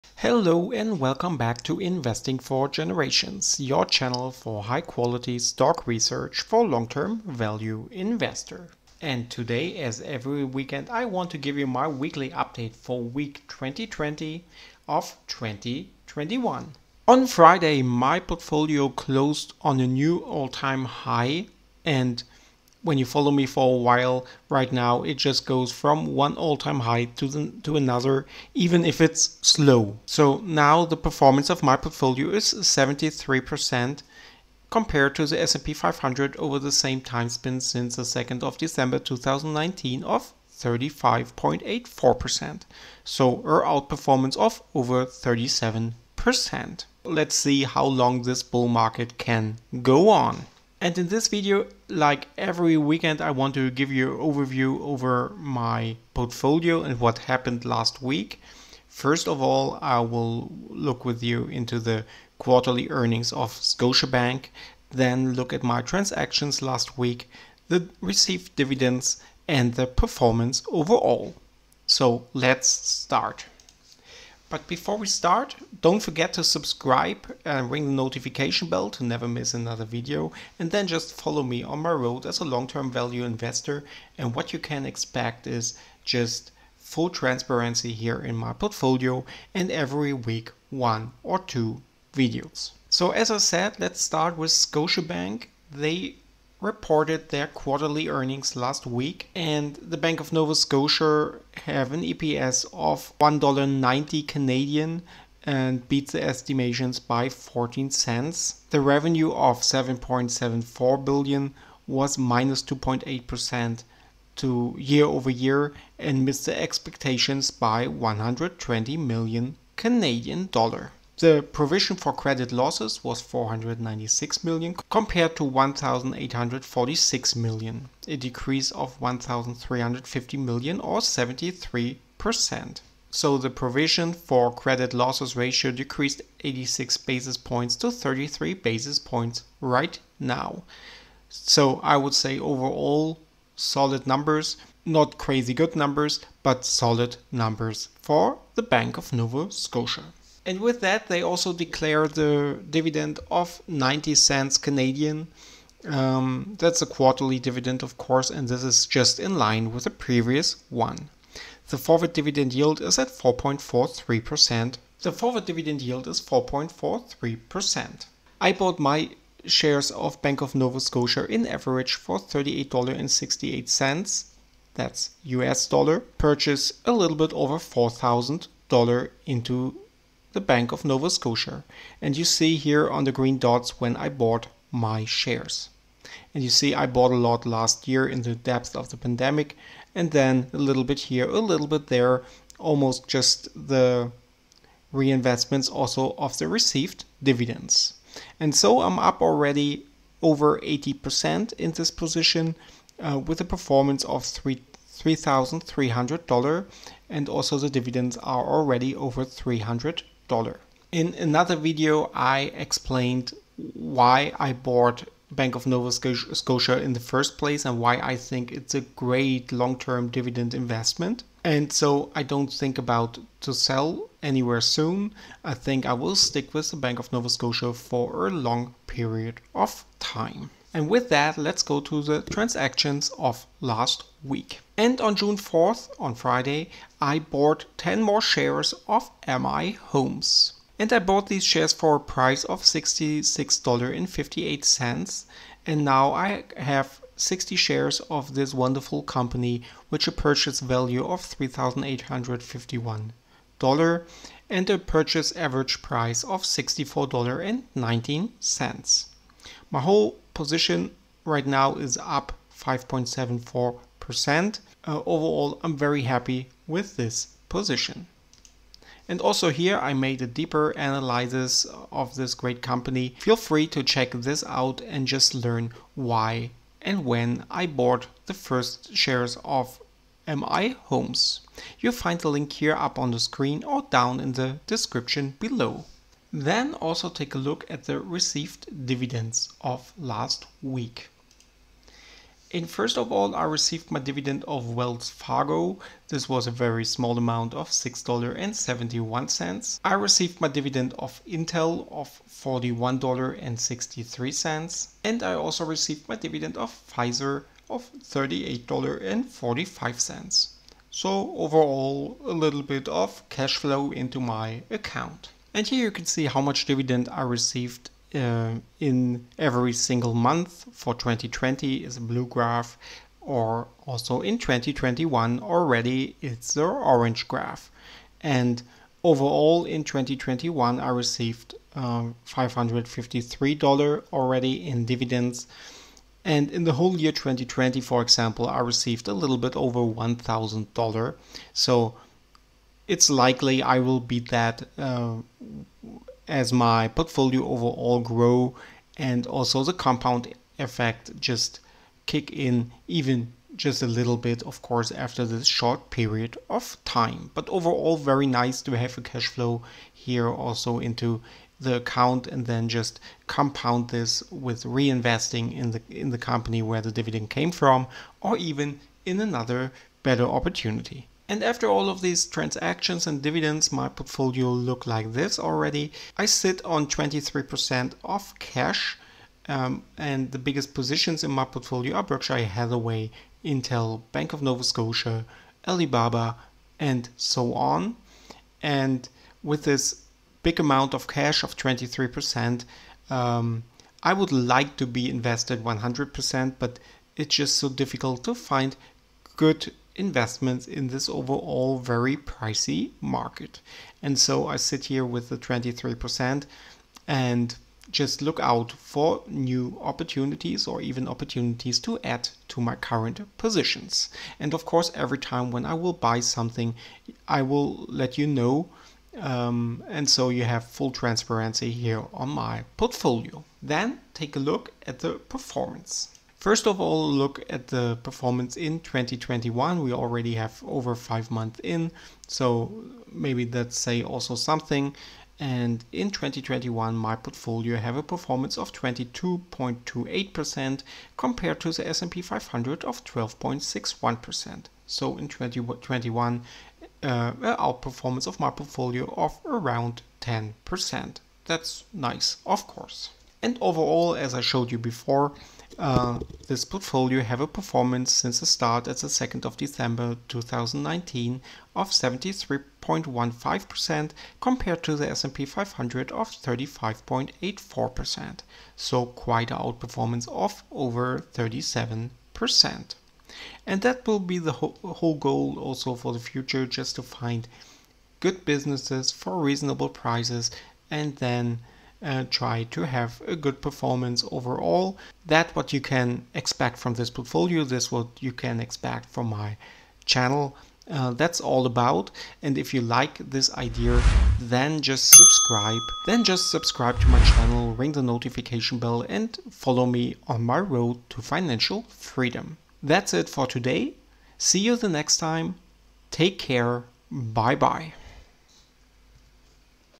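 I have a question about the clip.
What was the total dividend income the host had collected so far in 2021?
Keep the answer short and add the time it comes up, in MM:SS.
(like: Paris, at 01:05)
$553, at 05:32.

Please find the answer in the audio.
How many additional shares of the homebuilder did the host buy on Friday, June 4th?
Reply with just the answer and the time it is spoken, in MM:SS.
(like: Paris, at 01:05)
10, at 03:57.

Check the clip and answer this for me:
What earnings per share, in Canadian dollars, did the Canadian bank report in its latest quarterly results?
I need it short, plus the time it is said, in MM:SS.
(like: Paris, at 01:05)
$1.90, at 01:43.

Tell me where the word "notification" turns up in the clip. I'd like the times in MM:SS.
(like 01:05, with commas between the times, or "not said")
01:17, 08:18.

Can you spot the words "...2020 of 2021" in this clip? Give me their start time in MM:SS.
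00:13.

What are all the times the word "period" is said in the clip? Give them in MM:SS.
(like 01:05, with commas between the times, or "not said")
03:48, 05:55.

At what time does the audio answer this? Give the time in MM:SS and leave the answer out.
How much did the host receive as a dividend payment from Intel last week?
05:02.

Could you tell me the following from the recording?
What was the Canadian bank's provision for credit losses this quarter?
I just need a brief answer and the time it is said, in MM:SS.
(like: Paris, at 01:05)
496 million, at 02:03.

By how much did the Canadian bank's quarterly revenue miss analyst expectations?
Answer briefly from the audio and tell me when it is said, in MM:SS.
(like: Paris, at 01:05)
120 million Canadian dollars, at 01:57.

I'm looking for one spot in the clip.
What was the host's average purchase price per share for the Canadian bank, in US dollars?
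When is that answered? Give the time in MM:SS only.
02:52.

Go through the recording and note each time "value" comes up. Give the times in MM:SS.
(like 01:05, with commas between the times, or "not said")
00:07, 01:22, 04:10.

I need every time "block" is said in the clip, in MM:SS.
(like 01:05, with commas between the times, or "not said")
not said.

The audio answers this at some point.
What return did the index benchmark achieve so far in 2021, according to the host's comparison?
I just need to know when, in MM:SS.
07:23.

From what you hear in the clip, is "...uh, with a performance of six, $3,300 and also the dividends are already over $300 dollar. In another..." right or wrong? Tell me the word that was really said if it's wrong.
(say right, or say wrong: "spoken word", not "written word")
wrong: "three", not "six".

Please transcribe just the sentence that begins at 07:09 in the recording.
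We already have over five months in, so maybe that say also something.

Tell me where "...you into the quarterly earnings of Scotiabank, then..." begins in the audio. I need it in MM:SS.
01:01.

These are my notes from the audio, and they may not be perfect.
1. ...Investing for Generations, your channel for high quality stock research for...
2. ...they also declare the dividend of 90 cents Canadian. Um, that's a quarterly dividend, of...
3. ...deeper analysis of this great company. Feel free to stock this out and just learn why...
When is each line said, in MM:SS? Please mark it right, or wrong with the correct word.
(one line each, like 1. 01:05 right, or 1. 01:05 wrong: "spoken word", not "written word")
1. 00:01 right
2. 02:31 right
3. 04:30 wrong: "check", not "stock".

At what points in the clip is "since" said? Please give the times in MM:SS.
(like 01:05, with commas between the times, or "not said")
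00:37, 07:38.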